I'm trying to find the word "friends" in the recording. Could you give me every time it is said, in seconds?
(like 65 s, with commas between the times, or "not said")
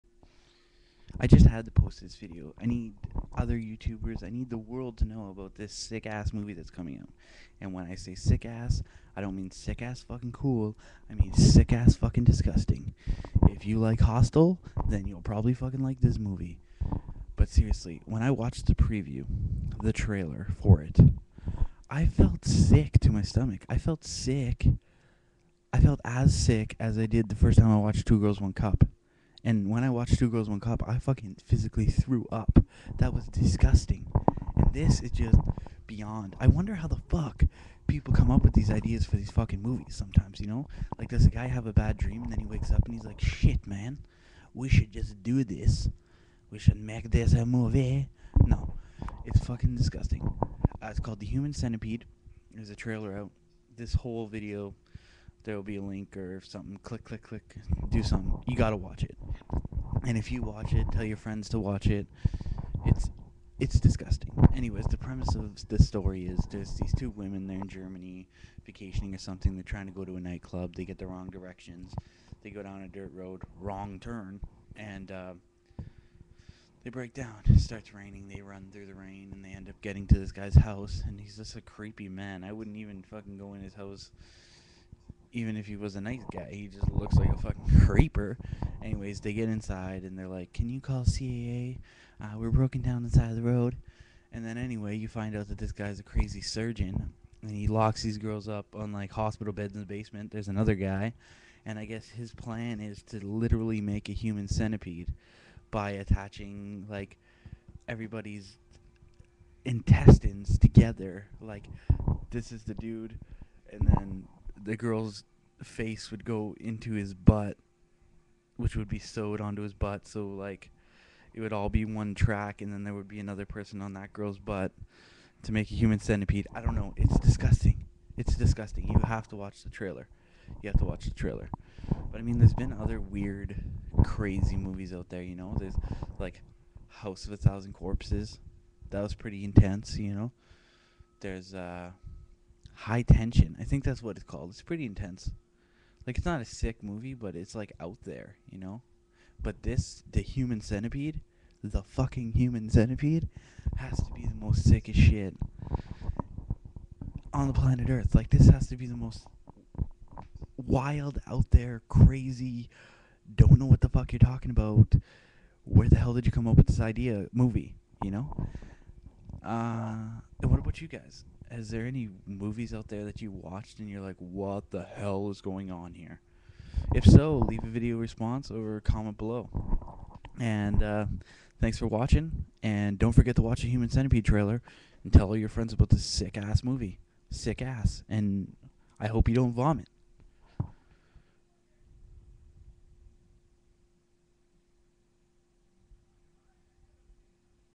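61 s, 185 s.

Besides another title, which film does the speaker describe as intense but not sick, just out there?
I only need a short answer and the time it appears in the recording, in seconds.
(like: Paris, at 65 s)
High Tension, at 142 s.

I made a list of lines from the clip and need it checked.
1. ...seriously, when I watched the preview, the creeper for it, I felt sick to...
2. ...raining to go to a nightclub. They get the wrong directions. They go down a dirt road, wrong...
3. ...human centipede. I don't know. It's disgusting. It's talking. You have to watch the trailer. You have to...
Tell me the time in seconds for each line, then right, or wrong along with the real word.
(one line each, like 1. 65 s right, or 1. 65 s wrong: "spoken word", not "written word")
1. 17 s wrong: "trailer", not "creeper"
2. 69 s wrong: "trying", not "raining"
3. 125 s wrong: "disgusting", not "talking".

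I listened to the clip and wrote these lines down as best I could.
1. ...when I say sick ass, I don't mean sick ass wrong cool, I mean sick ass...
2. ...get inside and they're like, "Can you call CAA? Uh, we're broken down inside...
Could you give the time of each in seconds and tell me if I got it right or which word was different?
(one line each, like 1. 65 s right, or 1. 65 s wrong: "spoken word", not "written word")
1. 7 s wrong: "fucking", not "wrong"
2. 89 s right.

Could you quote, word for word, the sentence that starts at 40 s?
Like does a guy have a bad dream and then he wakes up and he's like, "Shit, man.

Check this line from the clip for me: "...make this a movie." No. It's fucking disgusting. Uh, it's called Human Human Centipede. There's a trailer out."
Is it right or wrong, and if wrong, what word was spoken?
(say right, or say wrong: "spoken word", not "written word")
wrong: "The", not "Human".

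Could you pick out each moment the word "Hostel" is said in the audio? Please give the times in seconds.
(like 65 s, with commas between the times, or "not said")
13 s.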